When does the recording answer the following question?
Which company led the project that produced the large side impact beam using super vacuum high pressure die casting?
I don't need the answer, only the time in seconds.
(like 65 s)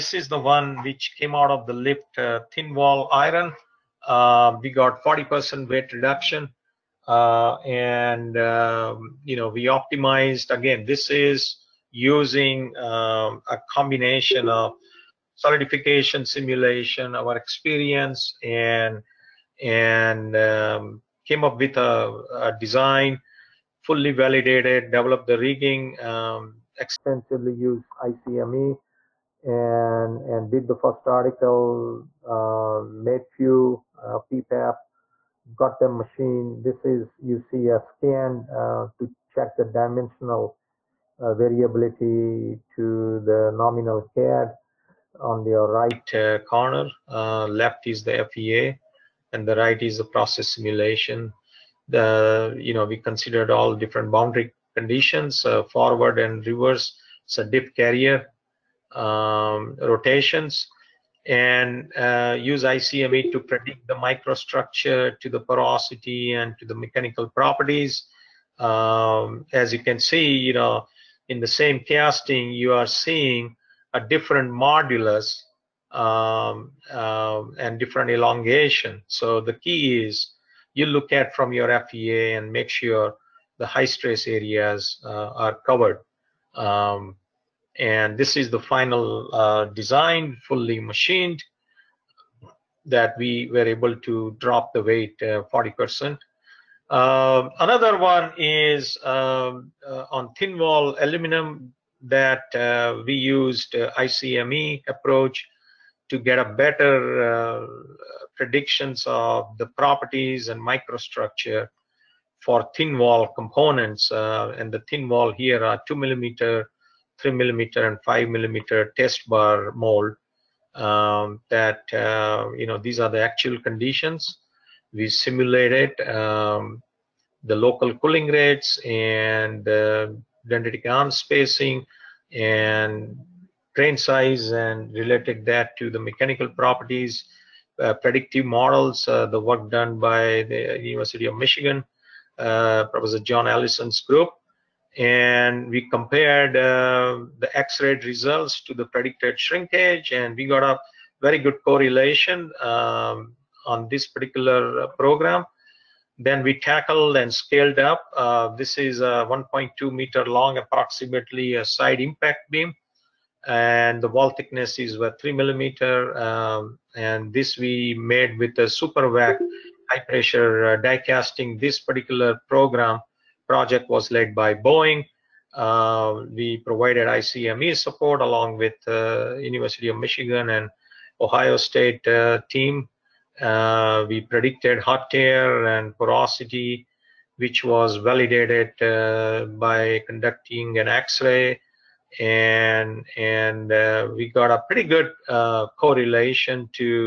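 174 s.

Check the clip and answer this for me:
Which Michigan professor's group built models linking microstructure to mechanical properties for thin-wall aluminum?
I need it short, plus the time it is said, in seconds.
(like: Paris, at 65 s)
John Allison, at 143 s.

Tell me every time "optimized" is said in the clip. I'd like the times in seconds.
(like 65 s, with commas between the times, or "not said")
9 s.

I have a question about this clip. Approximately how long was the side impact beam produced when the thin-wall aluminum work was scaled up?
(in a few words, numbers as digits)
1.2 meters.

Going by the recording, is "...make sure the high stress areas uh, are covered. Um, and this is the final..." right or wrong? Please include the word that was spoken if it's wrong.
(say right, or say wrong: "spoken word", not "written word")
right.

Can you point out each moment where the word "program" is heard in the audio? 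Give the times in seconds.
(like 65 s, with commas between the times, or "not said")
154 s, 172 s.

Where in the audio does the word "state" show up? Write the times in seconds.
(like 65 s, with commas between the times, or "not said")
181 s.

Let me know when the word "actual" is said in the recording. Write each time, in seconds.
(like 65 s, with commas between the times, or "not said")
123 s.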